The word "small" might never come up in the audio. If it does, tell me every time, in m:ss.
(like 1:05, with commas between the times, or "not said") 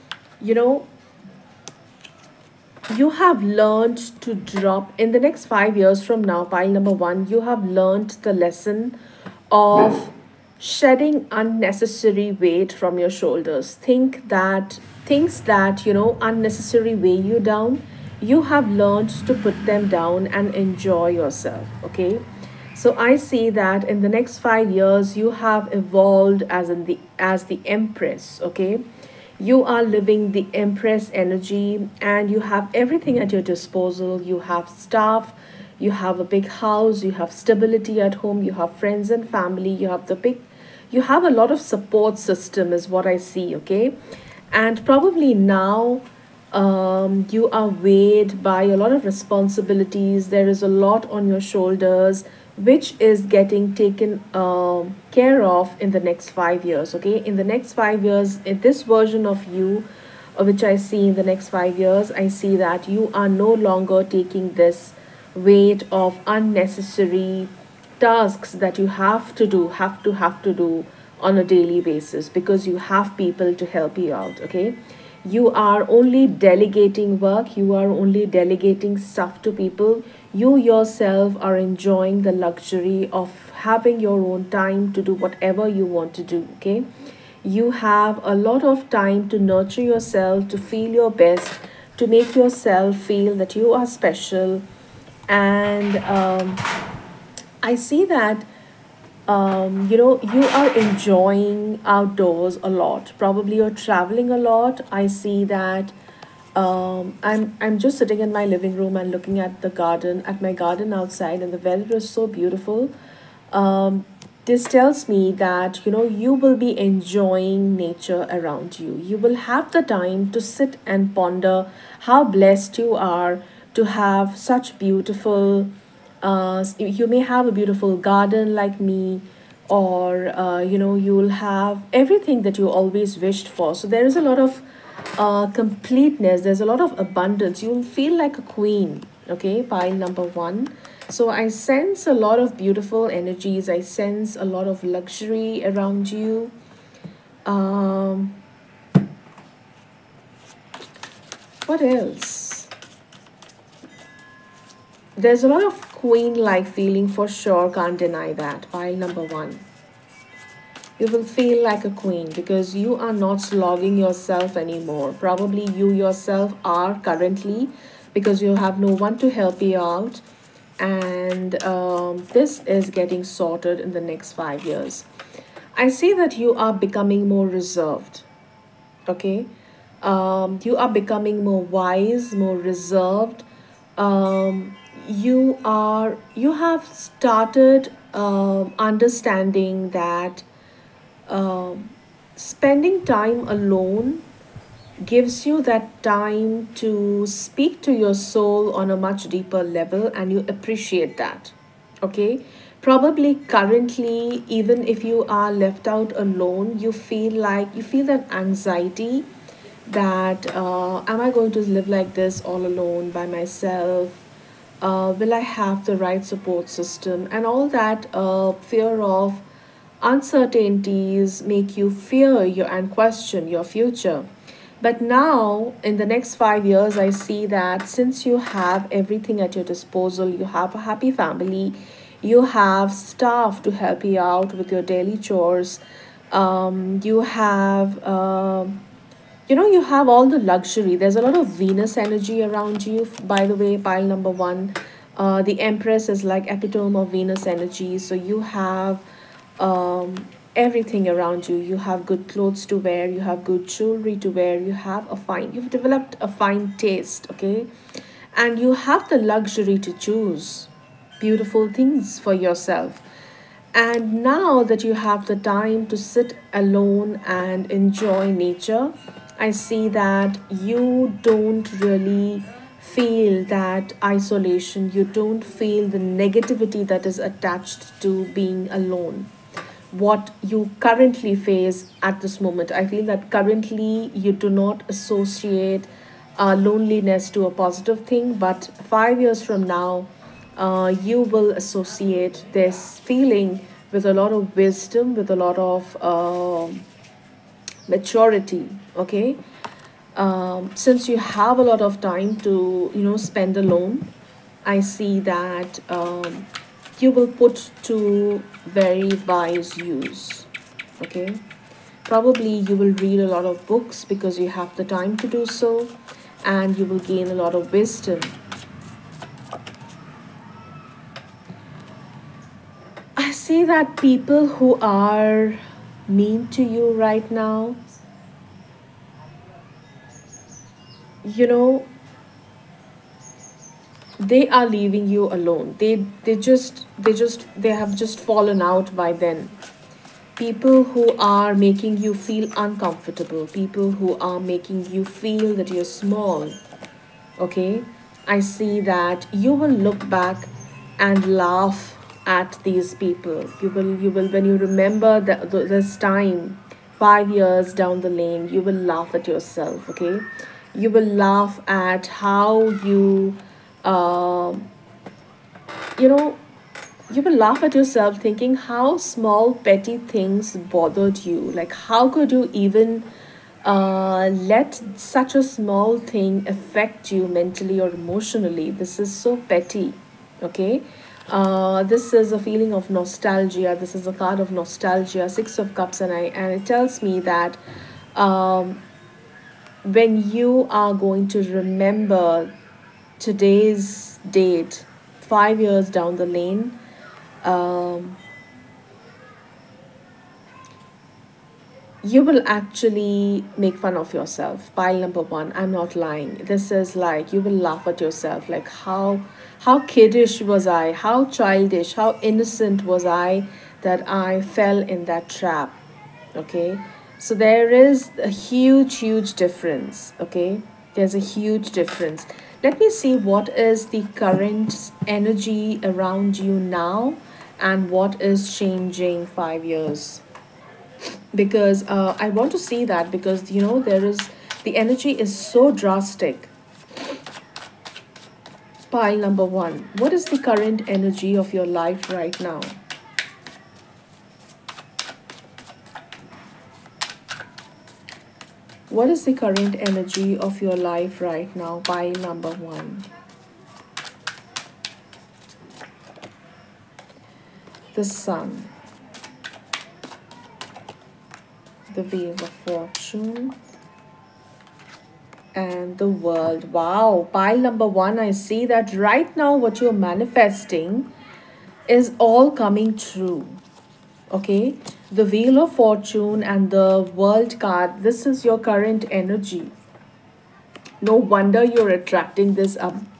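5:45, 6:08, 6:15.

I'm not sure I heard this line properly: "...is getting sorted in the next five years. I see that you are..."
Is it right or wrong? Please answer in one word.
right.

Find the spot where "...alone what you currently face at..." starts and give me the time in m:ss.
4:38.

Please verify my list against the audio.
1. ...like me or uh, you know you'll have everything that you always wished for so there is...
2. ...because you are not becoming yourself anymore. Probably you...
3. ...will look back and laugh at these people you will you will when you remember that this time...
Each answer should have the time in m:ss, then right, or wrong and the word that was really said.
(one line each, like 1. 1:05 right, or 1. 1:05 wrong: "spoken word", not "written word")
1. 2:08 right
2. 2:42 wrong: "slogging", not "becoming"
3. 5:49 right.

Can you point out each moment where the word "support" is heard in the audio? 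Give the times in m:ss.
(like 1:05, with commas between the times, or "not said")
0:41, 3:36.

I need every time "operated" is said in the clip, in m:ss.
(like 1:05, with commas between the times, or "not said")
not said.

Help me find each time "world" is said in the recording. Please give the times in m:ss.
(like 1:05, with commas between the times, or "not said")
7:46, 7:57.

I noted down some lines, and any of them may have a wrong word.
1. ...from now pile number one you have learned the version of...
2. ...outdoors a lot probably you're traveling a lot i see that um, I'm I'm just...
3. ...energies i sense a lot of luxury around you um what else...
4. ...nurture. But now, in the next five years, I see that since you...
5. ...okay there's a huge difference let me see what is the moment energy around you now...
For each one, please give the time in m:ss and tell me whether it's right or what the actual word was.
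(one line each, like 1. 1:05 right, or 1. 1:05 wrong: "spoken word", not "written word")
1. 0:06 wrong: "lesson", not "version"
2. 1:41 right
3. 2:23 right
4. 3:43 wrong: "future", not "nurture"
5. 7:00 wrong: "current", not "moment".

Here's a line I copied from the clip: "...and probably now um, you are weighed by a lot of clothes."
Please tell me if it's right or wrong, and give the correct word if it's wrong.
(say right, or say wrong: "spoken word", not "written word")
wrong: "responsibilities", not "clothes".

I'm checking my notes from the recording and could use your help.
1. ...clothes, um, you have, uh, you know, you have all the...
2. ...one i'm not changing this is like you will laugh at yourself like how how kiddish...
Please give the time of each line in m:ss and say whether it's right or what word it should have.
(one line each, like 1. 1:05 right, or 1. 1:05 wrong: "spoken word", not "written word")
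1. 3:55 wrong: "chores", not "clothes"
2. 6:45 wrong: "lying", not "changing".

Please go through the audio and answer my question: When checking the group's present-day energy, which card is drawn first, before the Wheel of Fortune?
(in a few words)
The Sun.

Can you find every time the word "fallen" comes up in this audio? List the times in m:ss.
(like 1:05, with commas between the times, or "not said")
5:38.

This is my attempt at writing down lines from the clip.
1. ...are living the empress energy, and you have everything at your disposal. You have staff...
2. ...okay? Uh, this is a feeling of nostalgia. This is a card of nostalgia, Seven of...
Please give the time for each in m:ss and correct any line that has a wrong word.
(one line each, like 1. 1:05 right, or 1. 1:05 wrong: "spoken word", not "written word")
1. 0:29 right
2. 6:20 wrong: "Six", not "Seven".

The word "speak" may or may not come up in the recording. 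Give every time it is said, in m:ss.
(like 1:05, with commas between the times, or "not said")
3:17.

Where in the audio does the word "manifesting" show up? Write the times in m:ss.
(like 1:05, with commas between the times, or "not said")
7:50.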